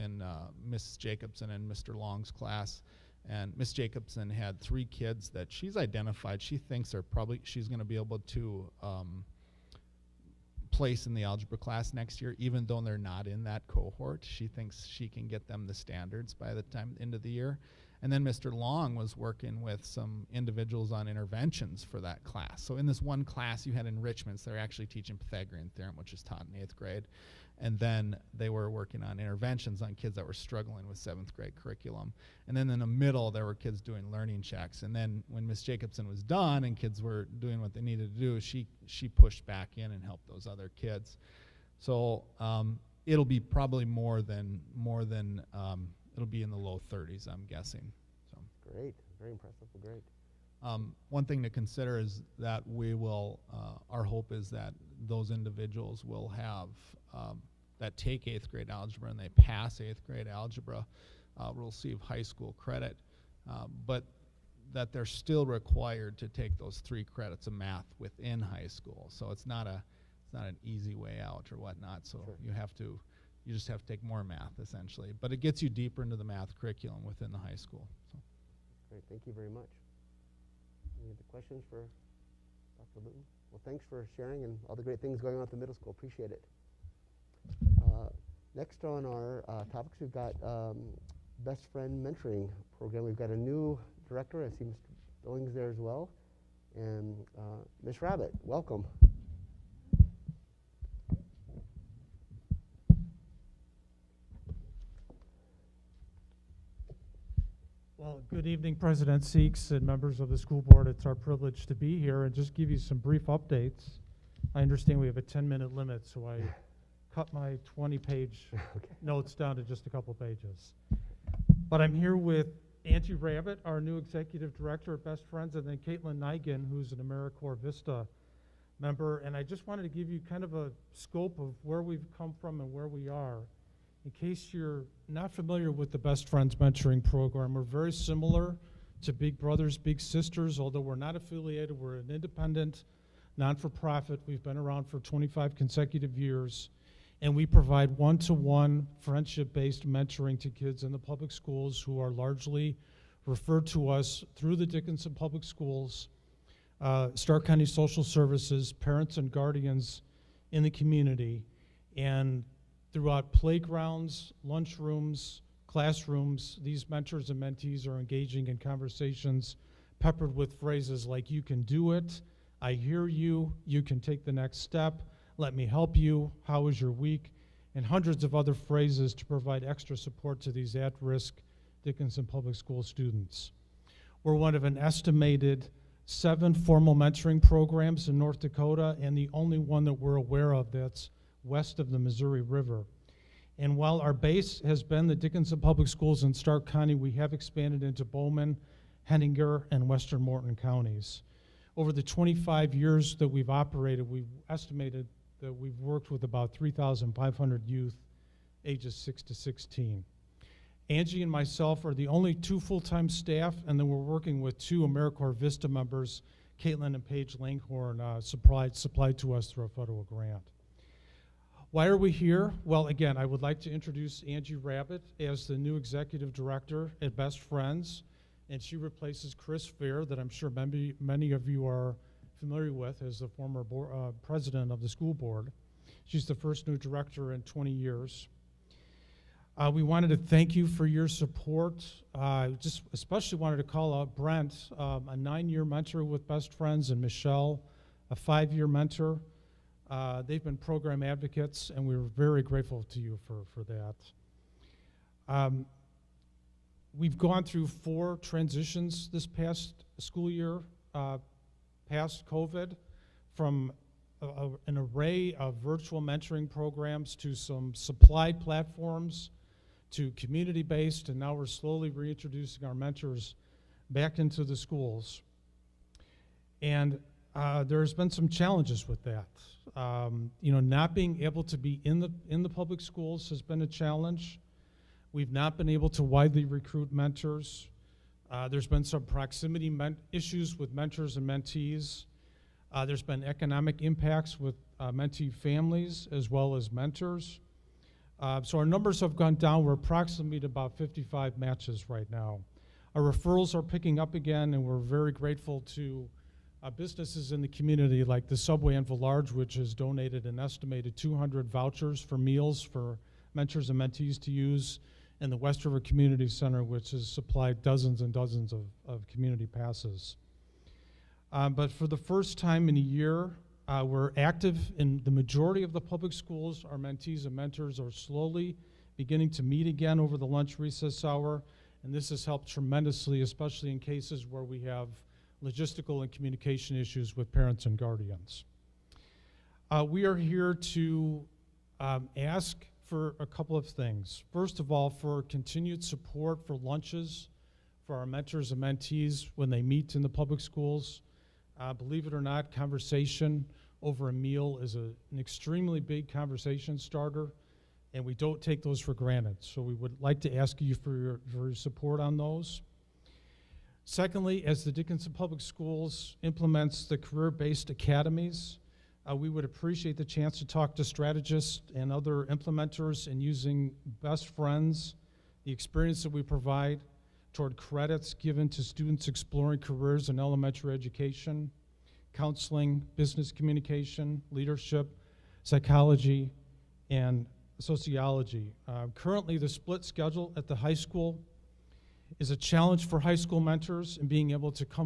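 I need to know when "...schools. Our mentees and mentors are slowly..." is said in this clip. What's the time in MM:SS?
05:26.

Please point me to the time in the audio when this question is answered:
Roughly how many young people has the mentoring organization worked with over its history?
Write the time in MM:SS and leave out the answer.
03:26.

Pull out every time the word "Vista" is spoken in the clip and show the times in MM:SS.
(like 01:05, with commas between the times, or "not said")
02:07, 03:35.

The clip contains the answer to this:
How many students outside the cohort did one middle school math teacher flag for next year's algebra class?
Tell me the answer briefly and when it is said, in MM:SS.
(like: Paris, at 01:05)
3, at 00:04.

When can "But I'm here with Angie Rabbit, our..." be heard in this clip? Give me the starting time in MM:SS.
02:01.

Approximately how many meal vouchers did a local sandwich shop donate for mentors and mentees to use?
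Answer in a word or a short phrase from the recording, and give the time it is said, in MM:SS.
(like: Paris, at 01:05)
200, at 05:10.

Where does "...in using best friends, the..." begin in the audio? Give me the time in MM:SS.
06:13.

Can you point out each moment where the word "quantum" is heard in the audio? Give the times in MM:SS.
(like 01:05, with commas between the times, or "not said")
not said.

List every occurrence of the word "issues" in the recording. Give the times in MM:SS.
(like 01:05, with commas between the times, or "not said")
04:50, 05:36.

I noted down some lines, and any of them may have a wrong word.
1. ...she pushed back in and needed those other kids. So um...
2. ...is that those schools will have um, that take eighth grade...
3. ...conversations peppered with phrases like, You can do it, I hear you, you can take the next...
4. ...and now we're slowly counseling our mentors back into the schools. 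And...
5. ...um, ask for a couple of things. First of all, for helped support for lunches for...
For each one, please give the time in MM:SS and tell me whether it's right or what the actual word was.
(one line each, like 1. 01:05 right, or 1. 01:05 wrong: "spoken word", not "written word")
1. 00:38 wrong: "helped", not "needed"
2. 00:54 wrong: "individuals", not "schools"
3. 02:48 right
4. 04:31 wrong: "reintroducing", not "counseling"
5. 05:41 wrong: "continued", not "helped".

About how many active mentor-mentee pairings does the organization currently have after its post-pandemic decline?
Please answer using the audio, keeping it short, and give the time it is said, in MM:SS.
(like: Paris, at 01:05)
55, at 05:00.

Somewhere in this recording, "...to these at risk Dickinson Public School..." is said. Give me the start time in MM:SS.
03:00.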